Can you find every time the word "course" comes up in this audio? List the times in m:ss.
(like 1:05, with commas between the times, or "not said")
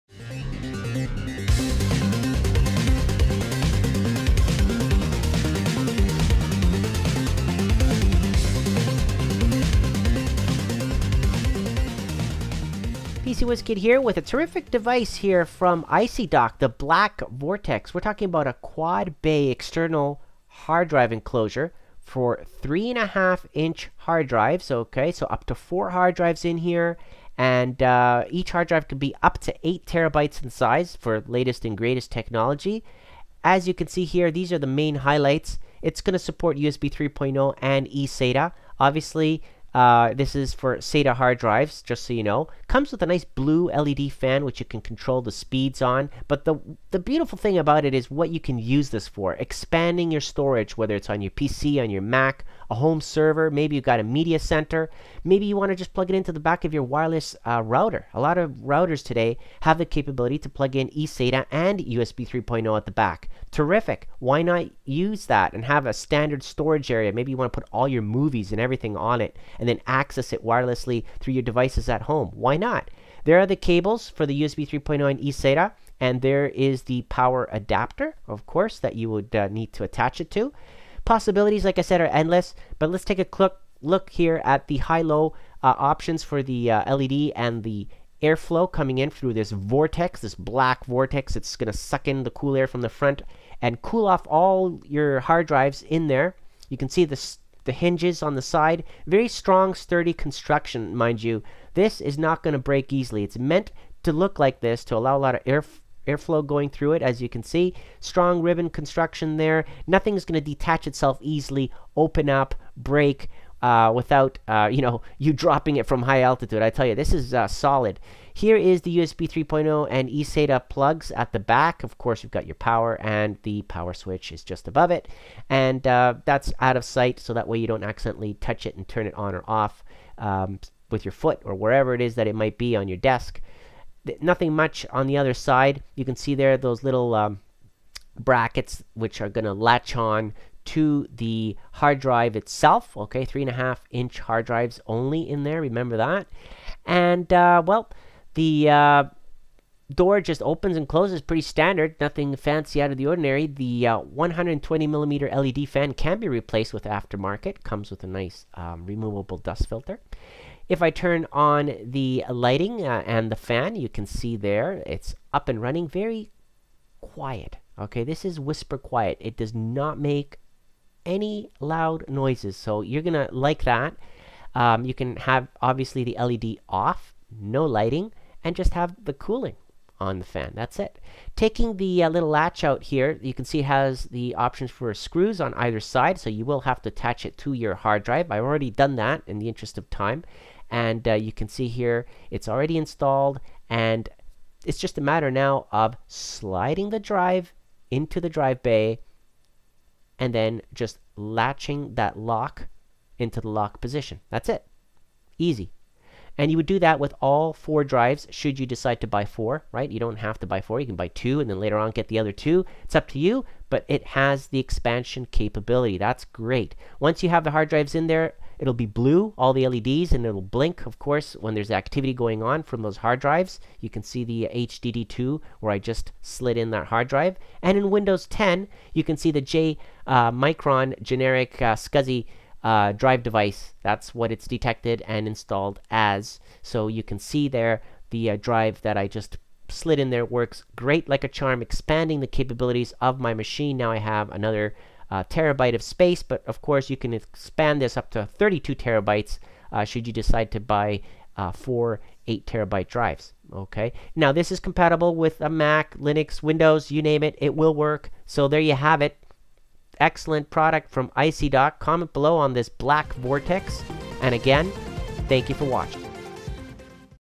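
1:18, 2:01, 3:40, 4:06.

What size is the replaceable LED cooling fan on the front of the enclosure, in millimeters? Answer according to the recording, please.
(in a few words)
120 millimeters.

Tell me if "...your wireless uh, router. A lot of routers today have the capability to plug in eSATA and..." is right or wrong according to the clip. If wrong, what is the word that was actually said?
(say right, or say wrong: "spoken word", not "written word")
right.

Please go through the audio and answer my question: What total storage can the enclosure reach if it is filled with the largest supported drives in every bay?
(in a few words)
32 terabytes.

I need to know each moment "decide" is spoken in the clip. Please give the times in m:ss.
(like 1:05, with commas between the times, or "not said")
3:28, 4:10.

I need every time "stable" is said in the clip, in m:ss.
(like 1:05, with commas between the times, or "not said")
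not said.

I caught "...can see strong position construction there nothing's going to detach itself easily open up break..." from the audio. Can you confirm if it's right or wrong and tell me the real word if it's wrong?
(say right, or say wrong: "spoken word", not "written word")
wrong: "ribbon", not "position".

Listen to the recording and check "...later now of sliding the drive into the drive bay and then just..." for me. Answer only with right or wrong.
wrong.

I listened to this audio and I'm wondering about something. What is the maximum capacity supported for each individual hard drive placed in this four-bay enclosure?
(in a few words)
8 terabytes.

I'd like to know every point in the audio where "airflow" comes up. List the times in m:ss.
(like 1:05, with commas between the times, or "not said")
1:28, 1:46.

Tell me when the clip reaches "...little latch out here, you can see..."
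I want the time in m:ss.
3:02.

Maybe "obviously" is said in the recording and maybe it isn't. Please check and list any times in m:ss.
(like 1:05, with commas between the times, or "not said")
0:38, 2:55.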